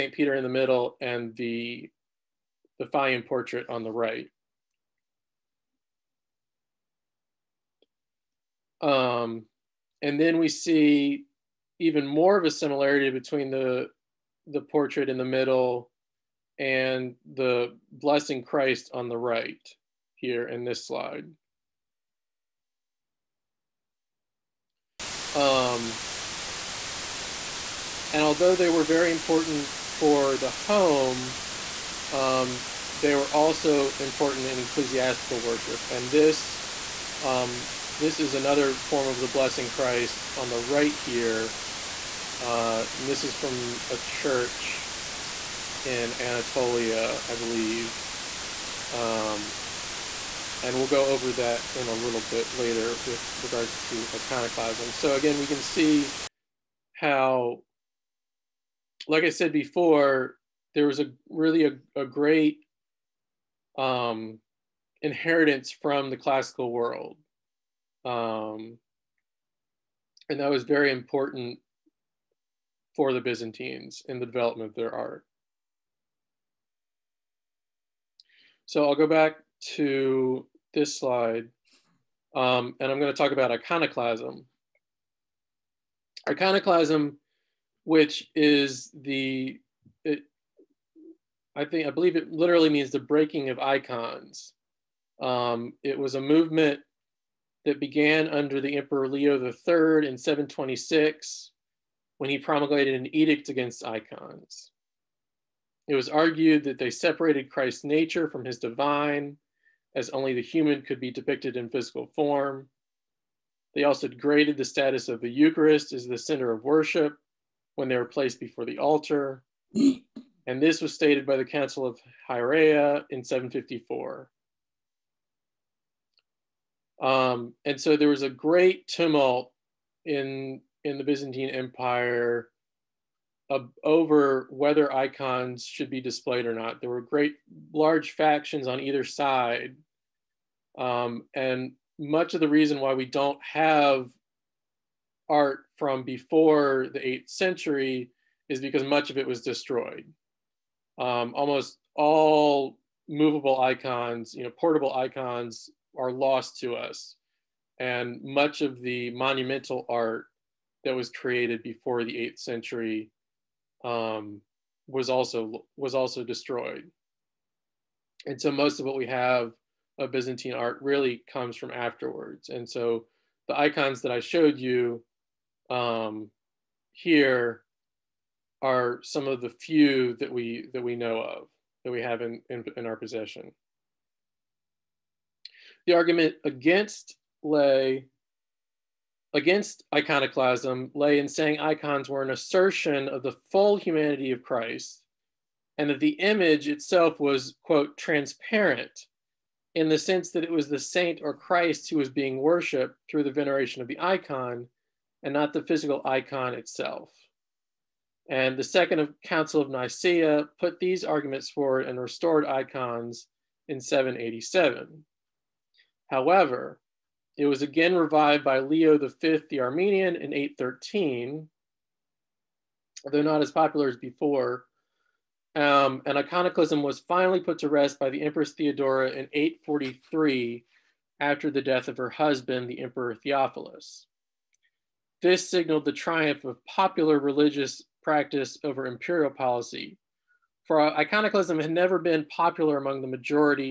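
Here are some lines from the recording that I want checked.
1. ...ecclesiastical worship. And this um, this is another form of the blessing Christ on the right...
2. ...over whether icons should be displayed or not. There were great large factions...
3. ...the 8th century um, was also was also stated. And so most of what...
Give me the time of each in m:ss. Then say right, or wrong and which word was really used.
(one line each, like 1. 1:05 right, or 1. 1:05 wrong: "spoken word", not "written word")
1. 0:34 right
2. 2:13 right
3. 2:42 wrong: "destroyed", not "stated".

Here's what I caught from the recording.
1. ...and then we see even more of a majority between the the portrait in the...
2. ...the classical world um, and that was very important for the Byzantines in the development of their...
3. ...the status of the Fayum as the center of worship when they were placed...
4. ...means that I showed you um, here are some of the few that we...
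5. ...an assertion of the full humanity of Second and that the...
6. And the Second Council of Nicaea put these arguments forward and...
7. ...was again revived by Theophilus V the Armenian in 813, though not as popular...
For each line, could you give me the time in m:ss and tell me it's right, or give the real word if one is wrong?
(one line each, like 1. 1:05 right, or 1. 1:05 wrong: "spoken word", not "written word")
1. 0:10 wrong: "similarity", not "majority"
2. 1:06 right
3. 1:54 wrong: "Eucharist", not "Fayum"
4. 2:53 wrong: "icons", not "means"
5. 3:12 wrong: "Christ", not "Second"
6. 3:28 right
7. 3:37 wrong: "Leo", not "Theophilus".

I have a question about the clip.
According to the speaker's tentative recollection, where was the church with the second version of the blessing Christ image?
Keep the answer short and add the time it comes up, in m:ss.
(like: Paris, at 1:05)
Anatolia, at 0:46.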